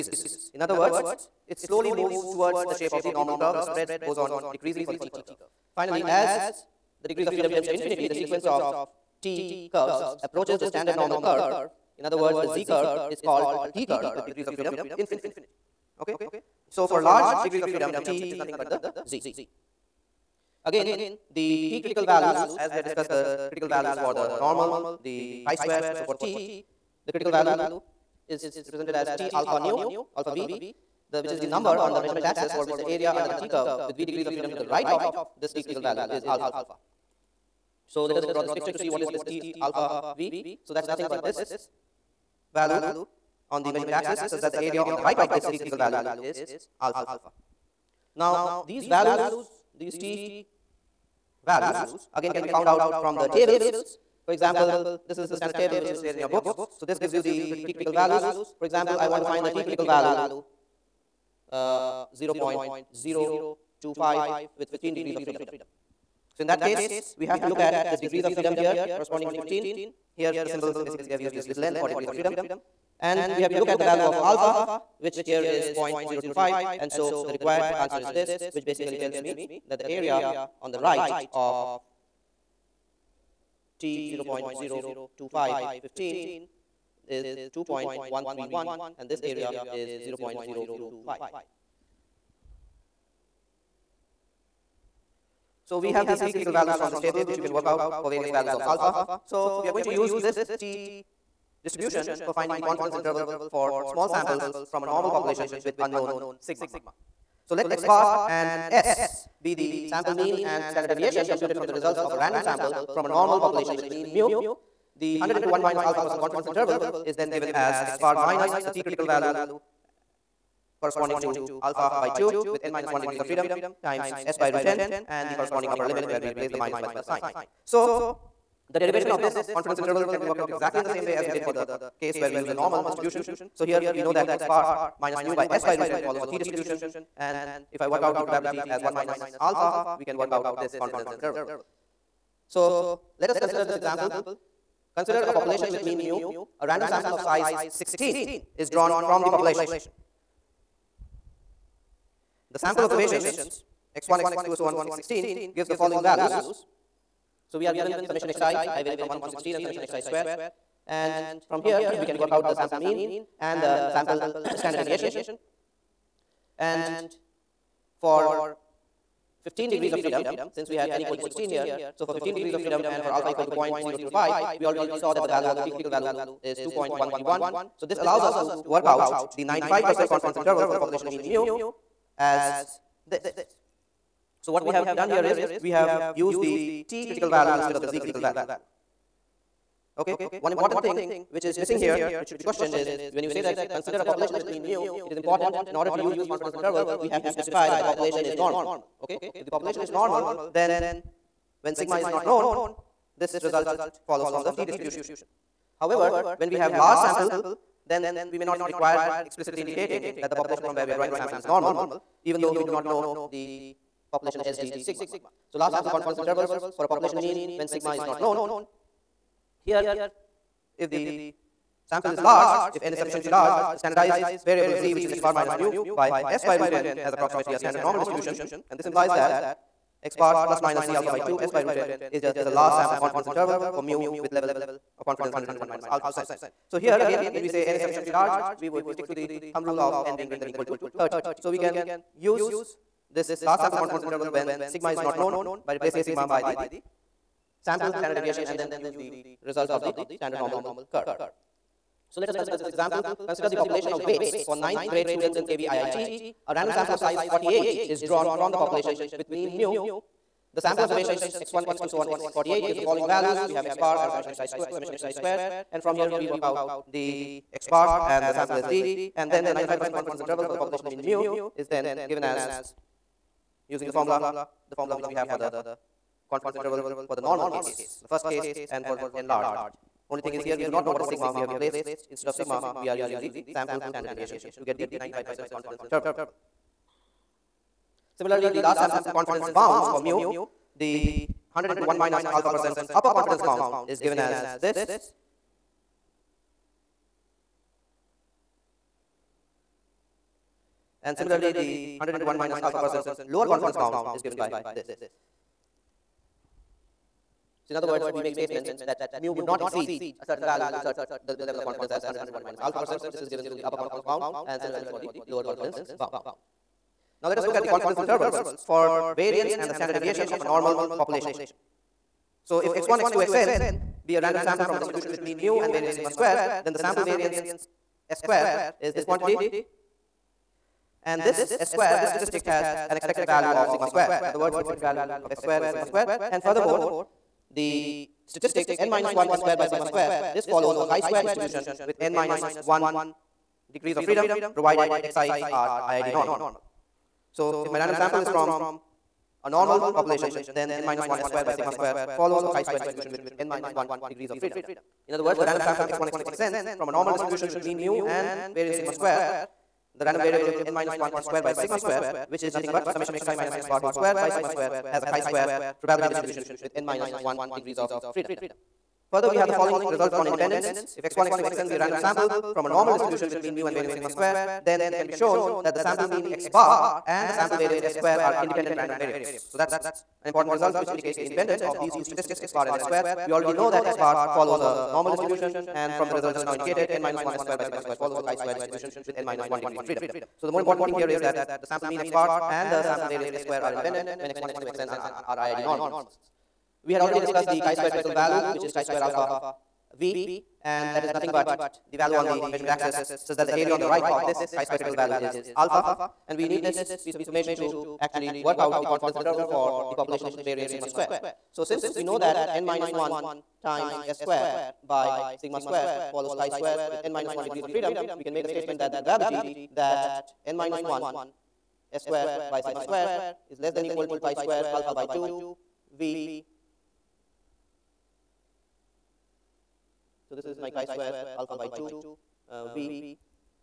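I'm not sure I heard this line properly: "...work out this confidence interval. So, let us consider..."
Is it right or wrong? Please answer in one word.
right.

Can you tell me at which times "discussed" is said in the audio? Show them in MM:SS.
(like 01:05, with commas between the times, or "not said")
00:22, 06:37.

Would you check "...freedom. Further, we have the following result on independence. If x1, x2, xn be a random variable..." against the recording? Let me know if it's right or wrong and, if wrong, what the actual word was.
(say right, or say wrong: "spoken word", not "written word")
wrong: "sample", not "variable".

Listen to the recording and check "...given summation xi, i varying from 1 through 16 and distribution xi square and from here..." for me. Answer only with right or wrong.
wrong.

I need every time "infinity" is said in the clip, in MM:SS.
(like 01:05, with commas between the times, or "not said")
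00:07, 00:14.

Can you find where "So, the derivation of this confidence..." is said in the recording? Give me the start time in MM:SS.
02:07.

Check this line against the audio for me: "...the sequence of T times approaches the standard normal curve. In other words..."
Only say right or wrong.
wrong.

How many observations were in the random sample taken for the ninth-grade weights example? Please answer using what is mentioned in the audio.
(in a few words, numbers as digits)
48.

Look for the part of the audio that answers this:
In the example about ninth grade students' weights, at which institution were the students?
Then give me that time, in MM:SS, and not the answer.
04:15.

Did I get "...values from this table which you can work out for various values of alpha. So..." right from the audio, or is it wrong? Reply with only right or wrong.
right.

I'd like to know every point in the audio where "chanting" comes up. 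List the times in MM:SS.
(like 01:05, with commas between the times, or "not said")
not said.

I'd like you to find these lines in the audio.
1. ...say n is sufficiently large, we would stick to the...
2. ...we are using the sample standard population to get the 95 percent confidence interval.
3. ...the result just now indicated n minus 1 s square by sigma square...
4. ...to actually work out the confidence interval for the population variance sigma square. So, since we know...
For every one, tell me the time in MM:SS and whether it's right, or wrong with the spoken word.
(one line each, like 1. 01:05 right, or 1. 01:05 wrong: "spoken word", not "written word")
1. 03:57 right
2. 04:42 wrong: "deviation", not "population"
3. 06:26 right
4. 06:47 right.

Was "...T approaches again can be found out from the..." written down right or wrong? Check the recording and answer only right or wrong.
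wrong.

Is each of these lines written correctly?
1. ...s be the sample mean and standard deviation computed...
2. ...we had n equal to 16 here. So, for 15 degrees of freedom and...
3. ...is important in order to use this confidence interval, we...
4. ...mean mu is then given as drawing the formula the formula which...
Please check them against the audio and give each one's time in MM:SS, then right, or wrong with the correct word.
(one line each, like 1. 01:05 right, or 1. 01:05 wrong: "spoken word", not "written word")
1. 01:48 right
2. 02:50 right
3. 03:15 right
4. 04:30 wrong: "using", not "drawing".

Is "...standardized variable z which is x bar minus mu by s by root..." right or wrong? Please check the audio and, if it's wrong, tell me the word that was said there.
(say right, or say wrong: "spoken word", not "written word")
right.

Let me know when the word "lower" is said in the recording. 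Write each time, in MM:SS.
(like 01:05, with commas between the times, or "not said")
05:03, 05:15.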